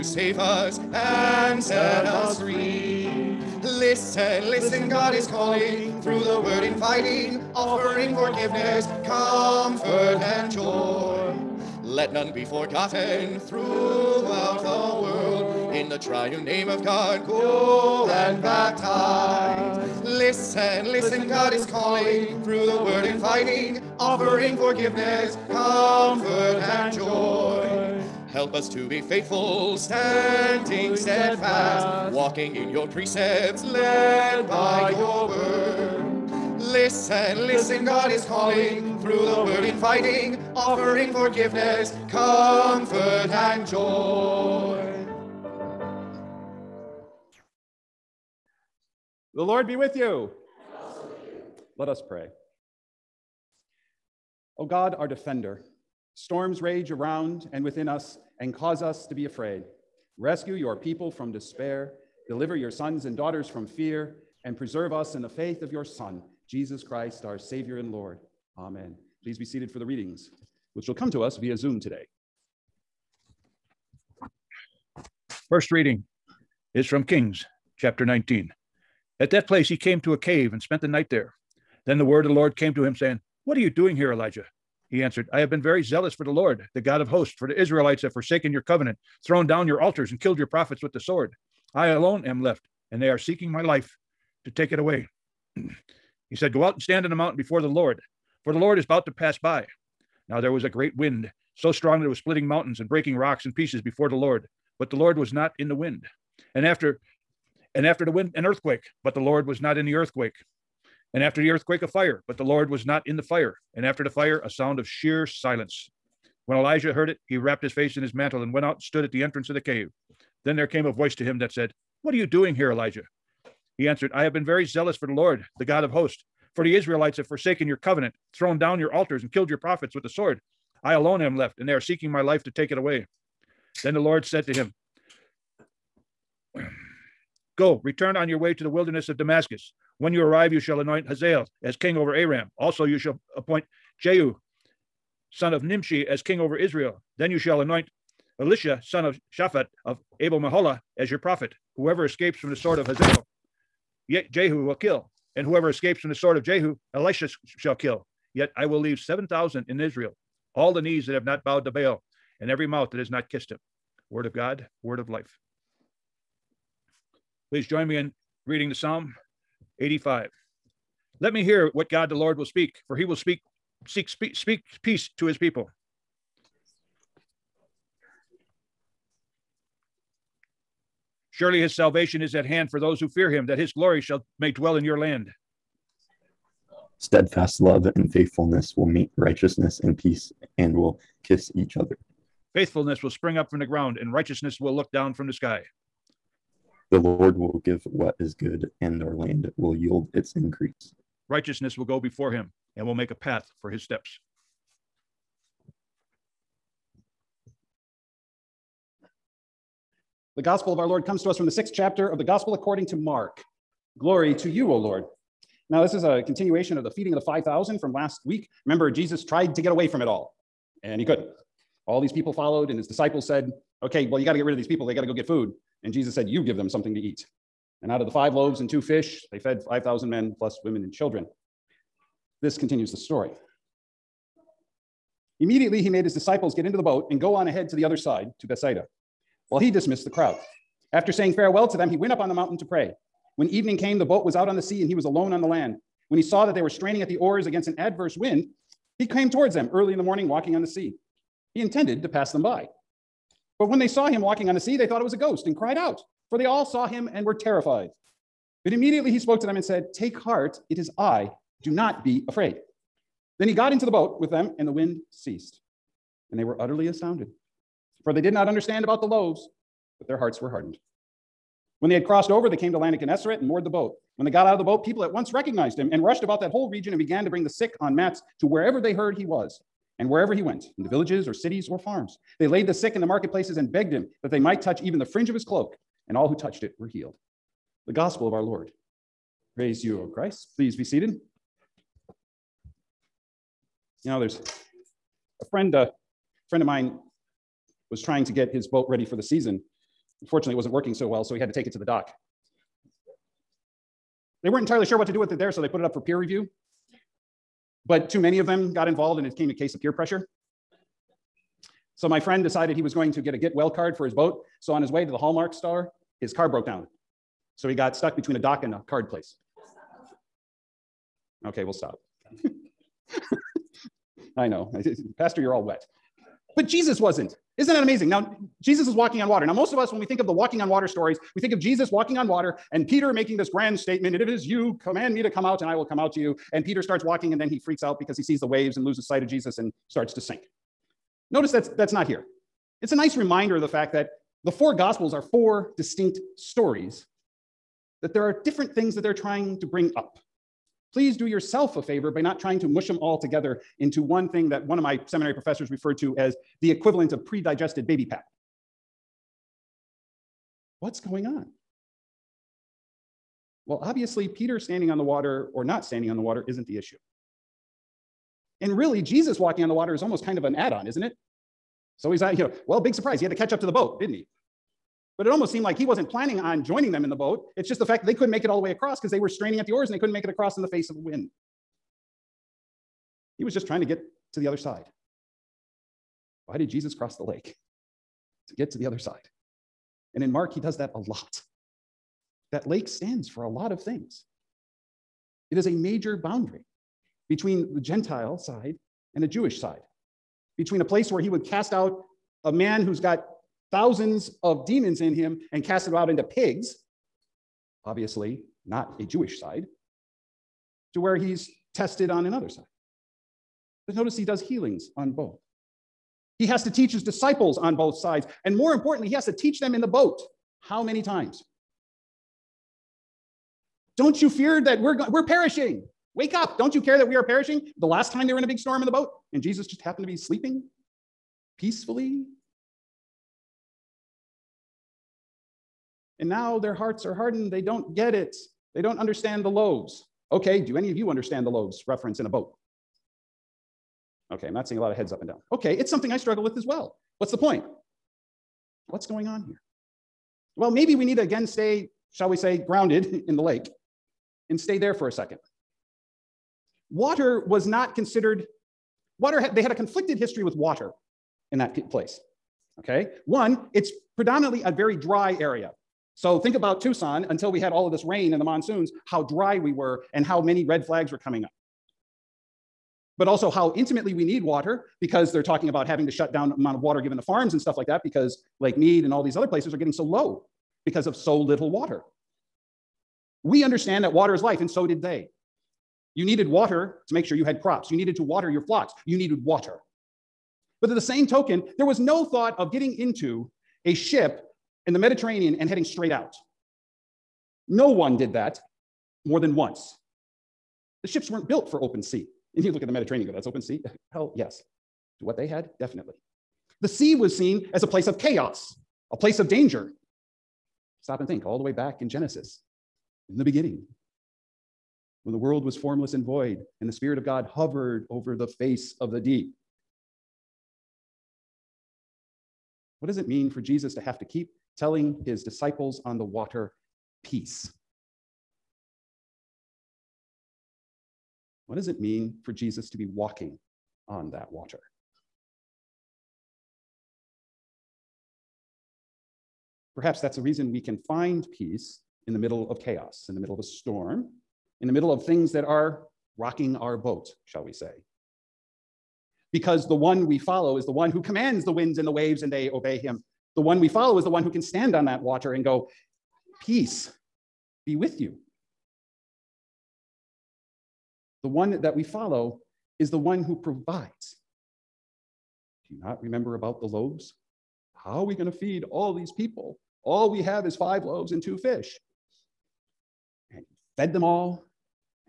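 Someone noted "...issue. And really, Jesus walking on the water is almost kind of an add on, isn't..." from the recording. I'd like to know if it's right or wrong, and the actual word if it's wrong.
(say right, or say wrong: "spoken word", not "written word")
right.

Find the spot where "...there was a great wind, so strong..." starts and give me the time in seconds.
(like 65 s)
100 s.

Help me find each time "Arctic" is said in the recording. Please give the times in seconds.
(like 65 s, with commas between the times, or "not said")
not said.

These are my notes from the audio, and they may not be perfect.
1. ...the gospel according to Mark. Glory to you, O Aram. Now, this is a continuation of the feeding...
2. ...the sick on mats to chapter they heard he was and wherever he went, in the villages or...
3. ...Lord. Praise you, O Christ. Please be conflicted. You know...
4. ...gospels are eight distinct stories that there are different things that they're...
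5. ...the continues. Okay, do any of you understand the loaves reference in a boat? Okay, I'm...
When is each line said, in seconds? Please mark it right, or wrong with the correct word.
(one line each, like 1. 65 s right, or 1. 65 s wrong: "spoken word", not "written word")
1. 212 s wrong: "Lord", not "Aram"
2. 277 s wrong: "wherever", not "chapter"
3. 288 s wrong: "seated", not "conflicted"
4. 344 s wrong: "four", not "eight"
5. 439 s wrong: "loaves", not "continues".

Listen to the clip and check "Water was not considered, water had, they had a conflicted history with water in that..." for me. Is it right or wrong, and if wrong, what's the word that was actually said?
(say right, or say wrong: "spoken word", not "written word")
right.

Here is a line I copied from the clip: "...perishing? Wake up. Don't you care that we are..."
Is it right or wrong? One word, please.
right.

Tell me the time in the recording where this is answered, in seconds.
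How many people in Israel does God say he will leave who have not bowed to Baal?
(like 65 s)
158 s.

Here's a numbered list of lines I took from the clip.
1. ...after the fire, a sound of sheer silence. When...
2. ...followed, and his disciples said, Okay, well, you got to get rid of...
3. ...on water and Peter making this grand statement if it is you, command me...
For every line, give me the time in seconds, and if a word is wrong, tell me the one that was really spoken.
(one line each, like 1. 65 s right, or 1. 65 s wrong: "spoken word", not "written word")
1. 113 s right
2. 222 s right
3. 332 s right.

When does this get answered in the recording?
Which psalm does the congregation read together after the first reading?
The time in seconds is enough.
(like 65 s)
168 s.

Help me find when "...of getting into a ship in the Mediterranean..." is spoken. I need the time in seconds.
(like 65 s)
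492 s.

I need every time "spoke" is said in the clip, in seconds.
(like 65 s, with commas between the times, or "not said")
259 s.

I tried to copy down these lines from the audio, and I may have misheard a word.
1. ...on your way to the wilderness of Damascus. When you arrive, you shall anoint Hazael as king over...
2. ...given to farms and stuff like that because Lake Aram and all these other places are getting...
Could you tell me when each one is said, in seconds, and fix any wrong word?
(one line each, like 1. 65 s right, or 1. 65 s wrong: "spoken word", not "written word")
1. 138 s right
2. 476 s wrong: "Mead", not "Aram".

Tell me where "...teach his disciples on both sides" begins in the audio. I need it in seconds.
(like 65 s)
416 s.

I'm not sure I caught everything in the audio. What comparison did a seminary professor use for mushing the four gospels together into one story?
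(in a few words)
pre-digested baby pap.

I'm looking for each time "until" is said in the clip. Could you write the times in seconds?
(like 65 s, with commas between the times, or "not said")
467 s.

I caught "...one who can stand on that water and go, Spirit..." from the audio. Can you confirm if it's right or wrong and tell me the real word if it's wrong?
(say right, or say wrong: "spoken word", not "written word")
wrong: "Peace", not "Spirit".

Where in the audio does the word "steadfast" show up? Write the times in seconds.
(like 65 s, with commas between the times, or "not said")
30 s, 186 s.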